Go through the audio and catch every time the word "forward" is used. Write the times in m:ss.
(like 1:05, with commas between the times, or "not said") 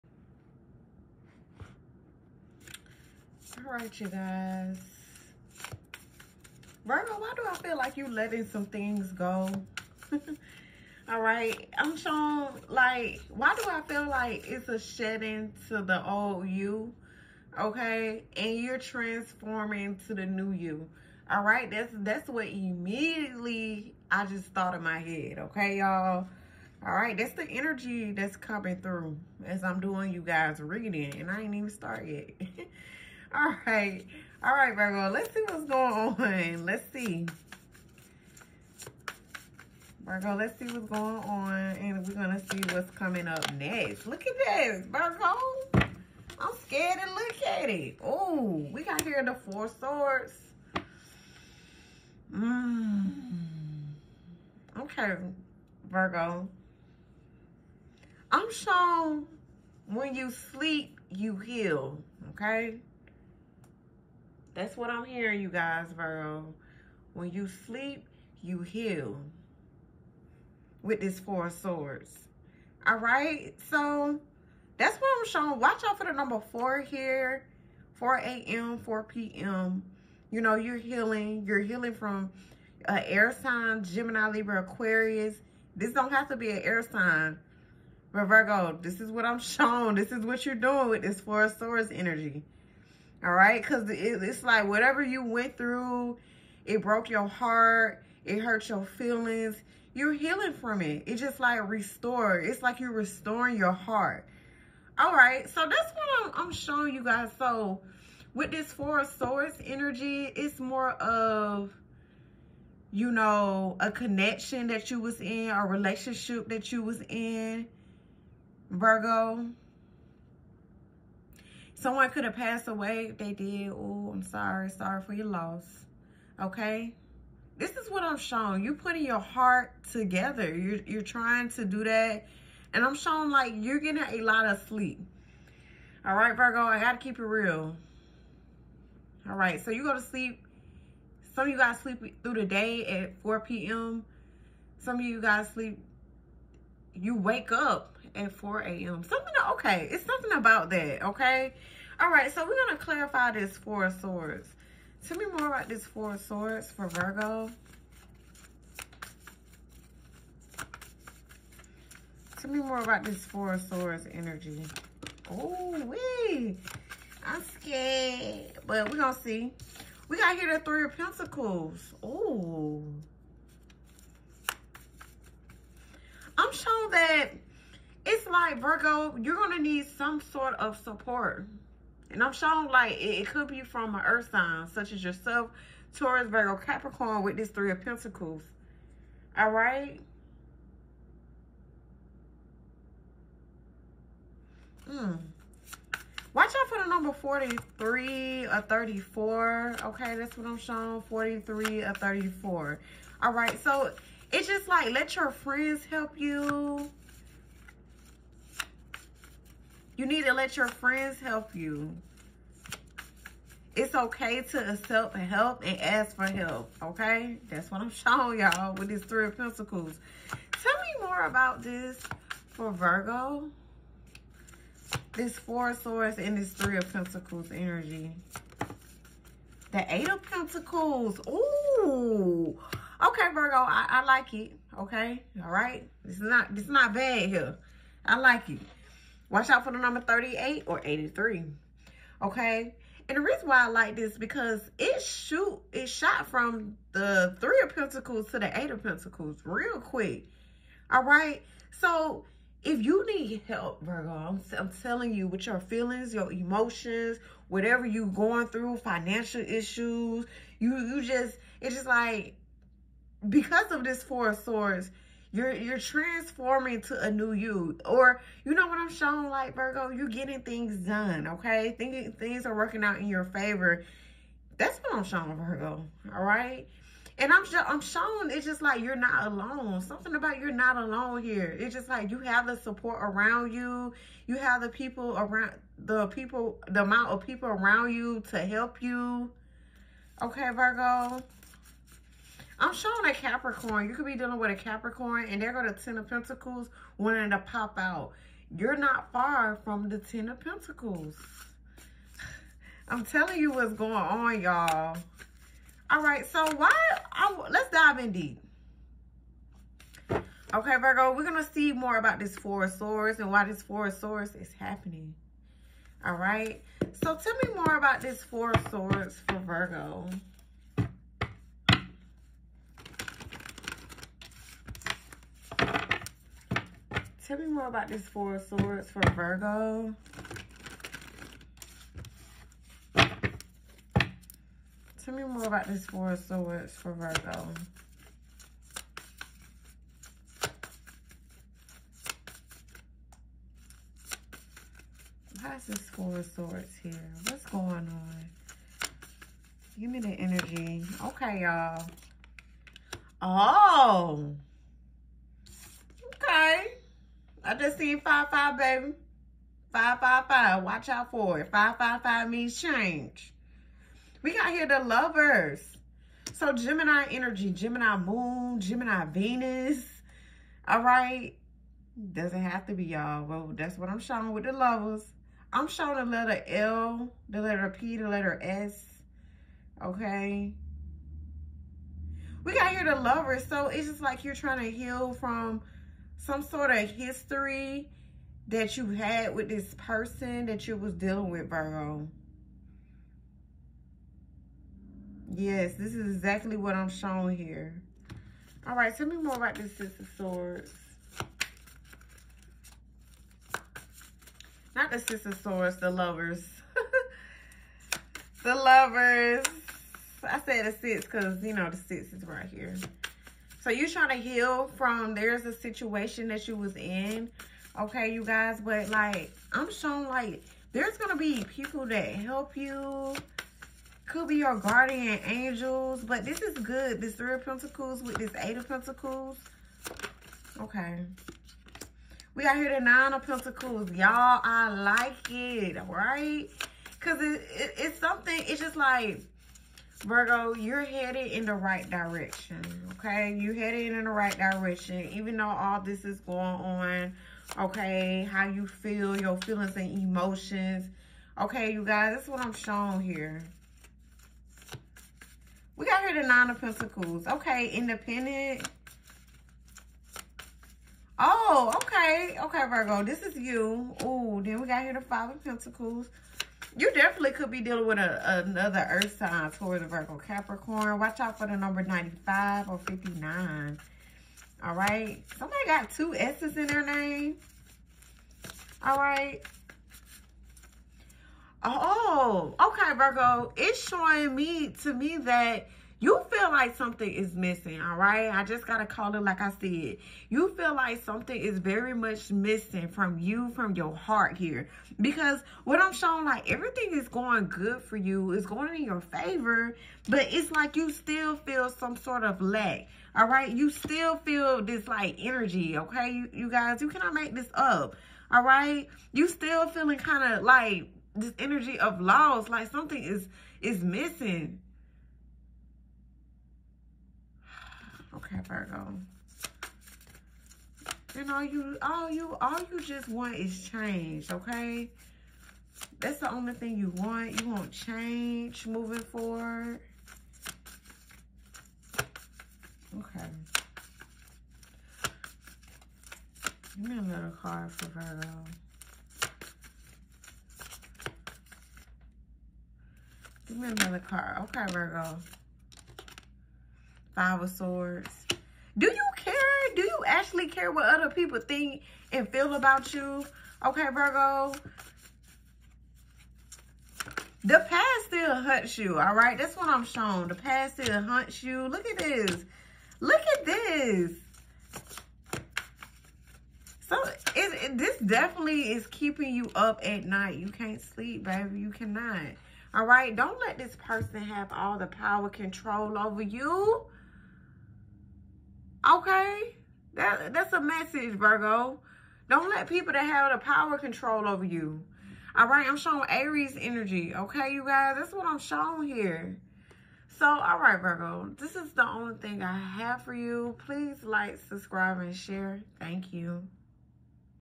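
8:48.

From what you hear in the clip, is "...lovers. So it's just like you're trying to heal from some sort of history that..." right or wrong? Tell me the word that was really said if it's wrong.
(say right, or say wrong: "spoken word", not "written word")
right.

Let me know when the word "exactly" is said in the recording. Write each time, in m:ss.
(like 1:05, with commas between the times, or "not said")
6:36.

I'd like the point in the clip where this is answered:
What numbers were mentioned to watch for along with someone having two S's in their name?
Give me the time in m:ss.
7:51.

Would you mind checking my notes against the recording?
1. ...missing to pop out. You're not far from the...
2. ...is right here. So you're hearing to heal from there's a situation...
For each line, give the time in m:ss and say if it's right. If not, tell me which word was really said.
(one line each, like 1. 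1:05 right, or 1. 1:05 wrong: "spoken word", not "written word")
1. 4:56 wrong: "wanting", not "missing"
2. 6:52 wrong: "trying", not "hearing".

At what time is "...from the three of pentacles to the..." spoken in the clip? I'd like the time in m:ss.
4:06.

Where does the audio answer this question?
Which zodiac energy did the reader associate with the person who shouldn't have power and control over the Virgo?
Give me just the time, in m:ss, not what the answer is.
9:46.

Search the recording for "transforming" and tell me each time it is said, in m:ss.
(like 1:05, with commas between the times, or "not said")
0:18, 4:25.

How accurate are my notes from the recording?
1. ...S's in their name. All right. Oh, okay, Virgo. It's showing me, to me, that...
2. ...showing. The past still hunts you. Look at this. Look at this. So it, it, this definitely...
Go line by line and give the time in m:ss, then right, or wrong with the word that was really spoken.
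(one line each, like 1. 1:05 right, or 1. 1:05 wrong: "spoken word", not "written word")
1. 7:56 right
2. 9:19 right.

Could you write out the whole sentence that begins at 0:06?
Virgo, why do I feel like you letting some things go?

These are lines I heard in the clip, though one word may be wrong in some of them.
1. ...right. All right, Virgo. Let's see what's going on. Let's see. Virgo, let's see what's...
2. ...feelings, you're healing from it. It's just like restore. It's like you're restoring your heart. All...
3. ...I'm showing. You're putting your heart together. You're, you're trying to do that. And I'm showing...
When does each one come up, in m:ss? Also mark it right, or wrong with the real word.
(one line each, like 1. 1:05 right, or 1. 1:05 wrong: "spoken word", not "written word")
1. 0:33 right
2. 1:38 right
3. 2:08 right.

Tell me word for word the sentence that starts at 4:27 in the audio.
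Or you know what I'm showing like Virgo, you're getting things done, okay?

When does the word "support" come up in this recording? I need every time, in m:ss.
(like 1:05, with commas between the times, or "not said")
3:00, 4:42.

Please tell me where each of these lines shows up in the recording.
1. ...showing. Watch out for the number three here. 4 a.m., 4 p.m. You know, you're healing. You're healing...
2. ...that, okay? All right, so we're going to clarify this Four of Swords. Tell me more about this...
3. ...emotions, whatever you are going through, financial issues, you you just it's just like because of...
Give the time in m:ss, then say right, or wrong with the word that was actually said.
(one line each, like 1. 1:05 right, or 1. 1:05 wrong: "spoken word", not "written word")
1. 1:15 wrong: "four", not "three"
2. 2:30 right
3. 4:16 right.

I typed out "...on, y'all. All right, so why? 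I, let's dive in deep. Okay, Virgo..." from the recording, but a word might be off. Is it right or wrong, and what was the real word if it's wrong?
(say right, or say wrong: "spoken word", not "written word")
right.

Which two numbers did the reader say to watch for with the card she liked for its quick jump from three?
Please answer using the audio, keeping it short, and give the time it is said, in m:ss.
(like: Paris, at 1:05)
38 or 83, at 4:00.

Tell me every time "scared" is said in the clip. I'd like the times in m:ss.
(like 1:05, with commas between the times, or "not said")
0:46, 2:47.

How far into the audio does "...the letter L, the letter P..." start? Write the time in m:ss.
6:15.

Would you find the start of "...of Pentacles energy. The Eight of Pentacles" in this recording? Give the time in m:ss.
3:46.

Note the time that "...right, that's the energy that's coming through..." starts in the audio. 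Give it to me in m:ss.
0:26.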